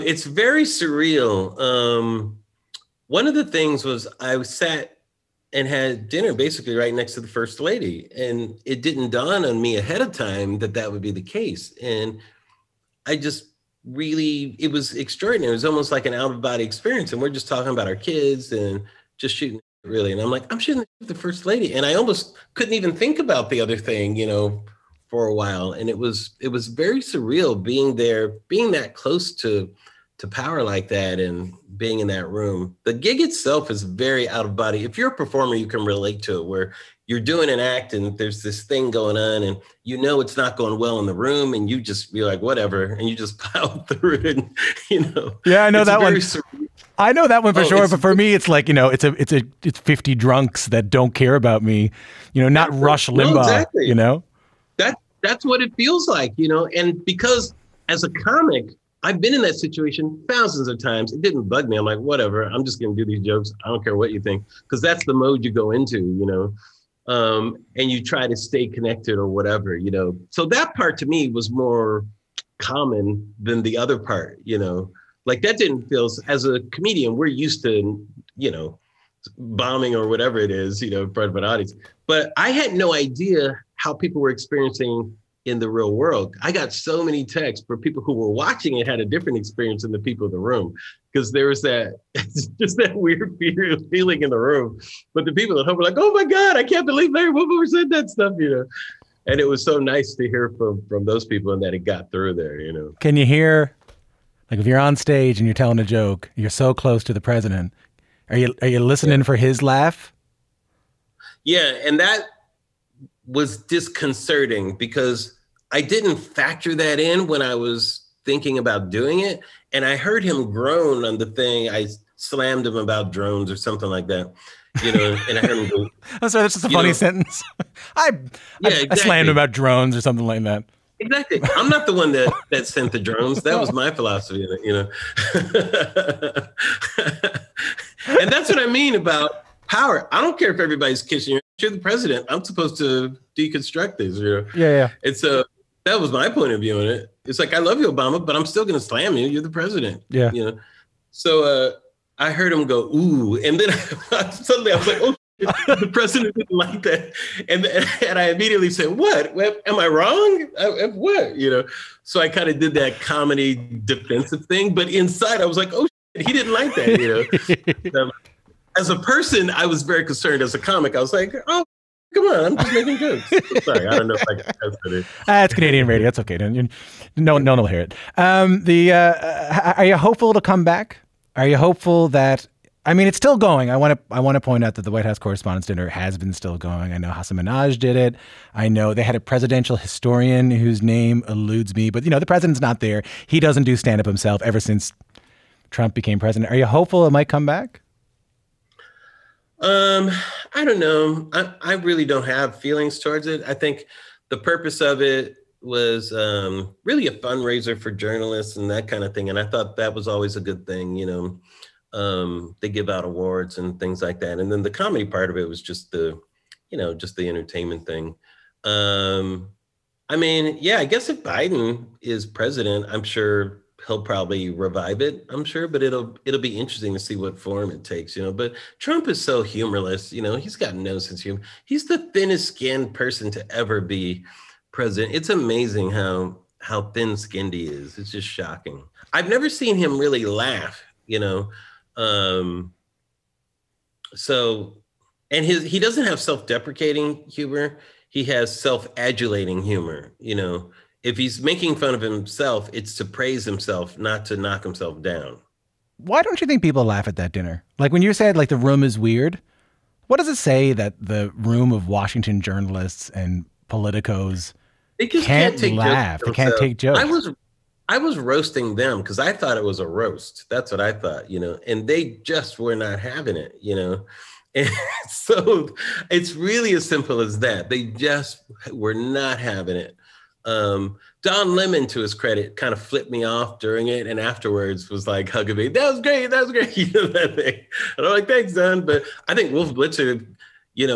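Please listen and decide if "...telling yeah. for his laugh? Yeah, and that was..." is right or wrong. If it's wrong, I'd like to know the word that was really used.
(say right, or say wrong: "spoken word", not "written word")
wrong: "listening", not "telling".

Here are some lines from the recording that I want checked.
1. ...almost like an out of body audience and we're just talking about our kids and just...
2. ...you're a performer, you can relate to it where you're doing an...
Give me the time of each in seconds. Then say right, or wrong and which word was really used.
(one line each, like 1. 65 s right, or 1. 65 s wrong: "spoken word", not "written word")
1. 15 s wrong: "experience", not "audience"
2. 34 s right.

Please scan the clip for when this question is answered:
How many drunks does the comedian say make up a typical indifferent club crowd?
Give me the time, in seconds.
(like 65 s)
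49 s.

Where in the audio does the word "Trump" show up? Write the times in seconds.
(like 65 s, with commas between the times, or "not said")
195 s, 228 s.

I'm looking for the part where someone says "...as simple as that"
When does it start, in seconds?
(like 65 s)
276 s.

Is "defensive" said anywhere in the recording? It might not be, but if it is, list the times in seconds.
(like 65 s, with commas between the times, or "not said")
163 s.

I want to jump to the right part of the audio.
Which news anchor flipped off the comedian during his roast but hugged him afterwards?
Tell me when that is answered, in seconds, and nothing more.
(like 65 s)
281 s.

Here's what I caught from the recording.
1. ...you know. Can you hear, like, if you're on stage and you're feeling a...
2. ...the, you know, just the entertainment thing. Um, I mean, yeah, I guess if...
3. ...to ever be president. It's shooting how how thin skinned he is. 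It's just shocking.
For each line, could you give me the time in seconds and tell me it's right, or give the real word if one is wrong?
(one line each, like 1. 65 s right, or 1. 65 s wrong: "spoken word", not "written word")
1. 102 s wrong: "telling", not "feeling"
2. 215 s right
3. 233 s wrong: "amazing", not "shooting".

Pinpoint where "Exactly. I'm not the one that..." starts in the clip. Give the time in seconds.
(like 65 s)
130 s.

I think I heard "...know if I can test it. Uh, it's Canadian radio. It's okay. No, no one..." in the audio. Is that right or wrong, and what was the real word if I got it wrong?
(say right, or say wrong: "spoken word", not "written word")
right.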